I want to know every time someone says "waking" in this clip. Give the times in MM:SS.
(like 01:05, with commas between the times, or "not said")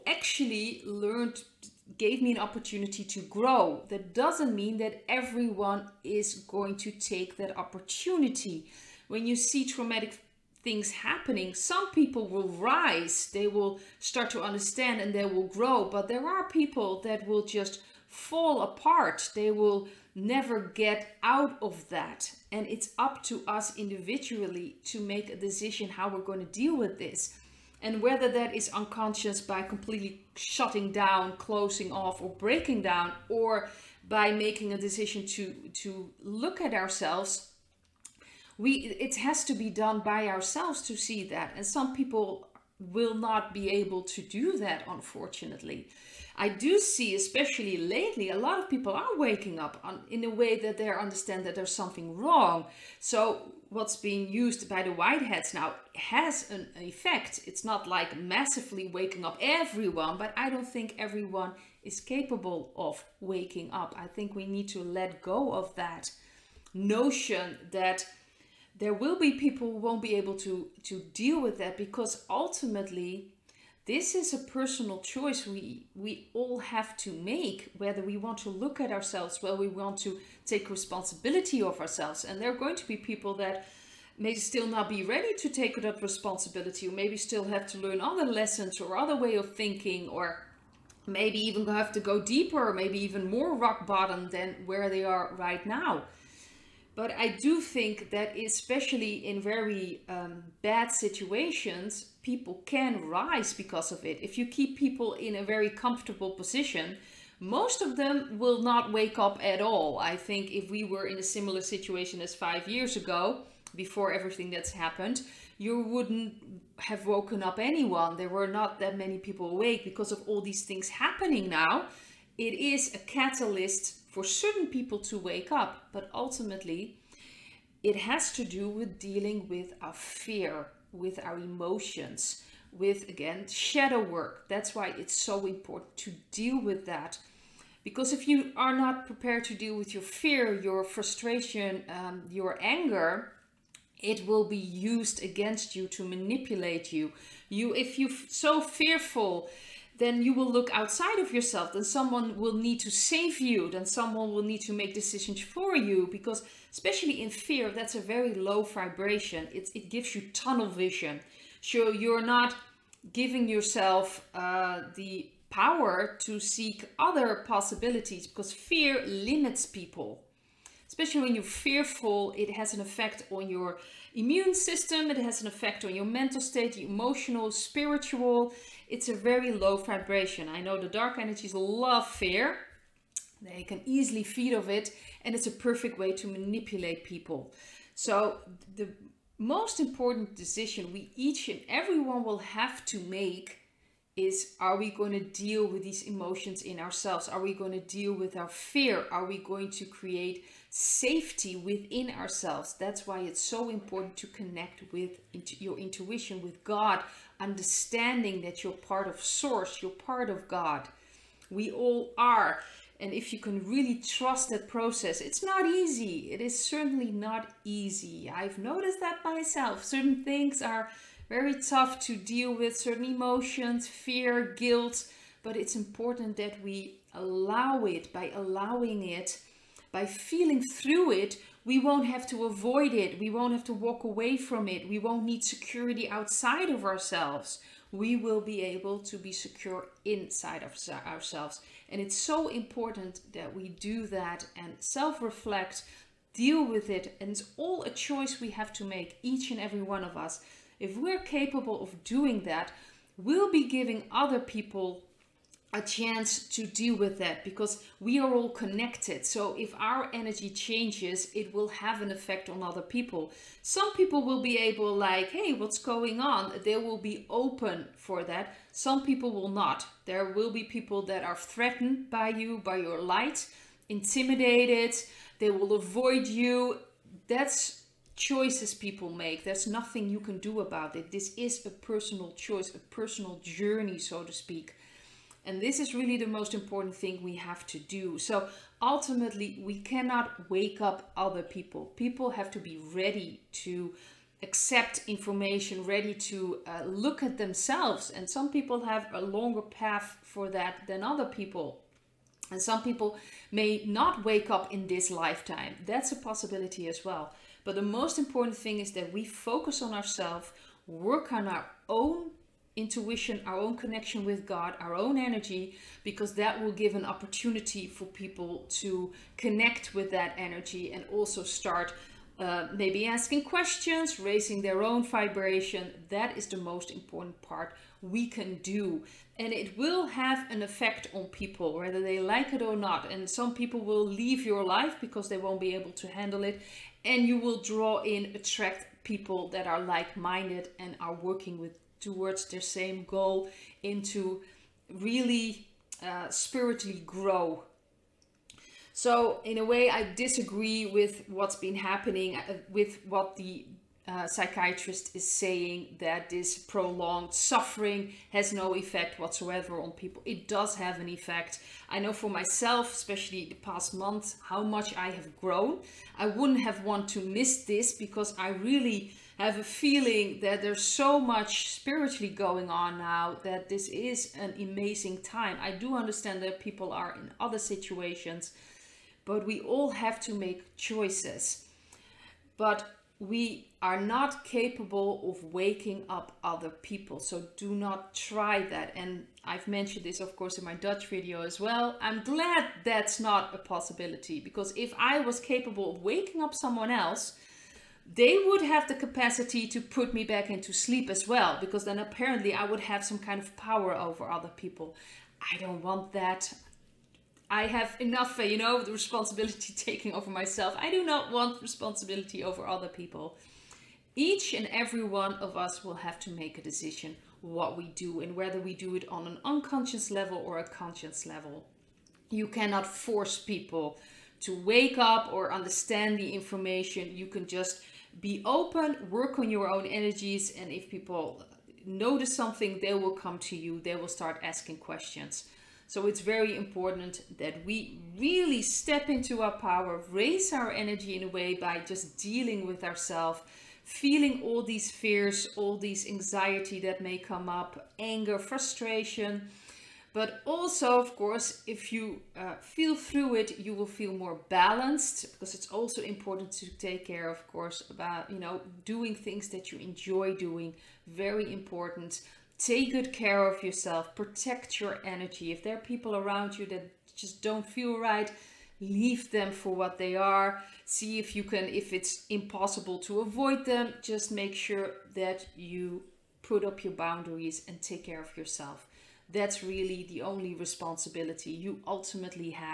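00:49, 00:58, 01:03, 06:25, 06:36.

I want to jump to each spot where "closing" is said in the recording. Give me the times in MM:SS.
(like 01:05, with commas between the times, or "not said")
00:31.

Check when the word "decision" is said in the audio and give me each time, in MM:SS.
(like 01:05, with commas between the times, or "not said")
00:25, 00:34, 02:34, 03:10, 06:56.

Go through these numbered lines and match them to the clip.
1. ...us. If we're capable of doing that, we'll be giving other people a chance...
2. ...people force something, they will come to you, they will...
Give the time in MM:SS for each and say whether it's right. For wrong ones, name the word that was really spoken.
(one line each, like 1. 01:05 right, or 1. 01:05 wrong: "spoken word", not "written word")
1. 04:10 right
2. 07:10 wrong: "notice", not "force".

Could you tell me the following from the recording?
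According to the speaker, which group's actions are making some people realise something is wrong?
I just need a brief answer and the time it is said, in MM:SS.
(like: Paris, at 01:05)
white hats, at 00:54.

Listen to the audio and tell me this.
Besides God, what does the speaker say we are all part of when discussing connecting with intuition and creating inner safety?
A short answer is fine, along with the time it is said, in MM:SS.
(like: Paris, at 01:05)
Source, at 03:29.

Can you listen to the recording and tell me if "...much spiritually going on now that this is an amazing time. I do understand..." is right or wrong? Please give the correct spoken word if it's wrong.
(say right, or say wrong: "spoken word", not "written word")
right.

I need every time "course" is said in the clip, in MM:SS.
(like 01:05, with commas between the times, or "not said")
06:30, 07:31, 07:37.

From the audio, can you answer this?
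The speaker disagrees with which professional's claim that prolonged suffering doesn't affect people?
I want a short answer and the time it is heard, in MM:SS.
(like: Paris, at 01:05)
psychiatrist, at 05:54.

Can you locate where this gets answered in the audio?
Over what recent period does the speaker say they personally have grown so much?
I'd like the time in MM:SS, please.
06:03.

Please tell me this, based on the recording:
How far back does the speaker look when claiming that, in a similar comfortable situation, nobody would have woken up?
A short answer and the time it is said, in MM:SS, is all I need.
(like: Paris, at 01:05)
5 years ago, at 01:52.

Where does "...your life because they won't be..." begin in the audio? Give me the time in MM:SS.
05:34.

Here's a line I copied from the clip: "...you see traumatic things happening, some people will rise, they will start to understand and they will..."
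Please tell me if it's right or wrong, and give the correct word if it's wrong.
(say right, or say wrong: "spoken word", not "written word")
right.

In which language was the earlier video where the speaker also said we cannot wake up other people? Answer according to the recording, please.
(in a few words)
Dutch.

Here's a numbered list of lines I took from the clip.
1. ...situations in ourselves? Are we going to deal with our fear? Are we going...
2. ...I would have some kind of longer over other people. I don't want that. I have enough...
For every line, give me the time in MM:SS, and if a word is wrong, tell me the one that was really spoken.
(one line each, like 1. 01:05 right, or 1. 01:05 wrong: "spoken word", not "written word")
1. 03:16 wrong: "emotions", not "situations"
2. 06:42 wrong: "power", not "longer".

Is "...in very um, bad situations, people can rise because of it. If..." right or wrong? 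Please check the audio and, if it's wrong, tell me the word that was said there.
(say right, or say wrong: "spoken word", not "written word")
right.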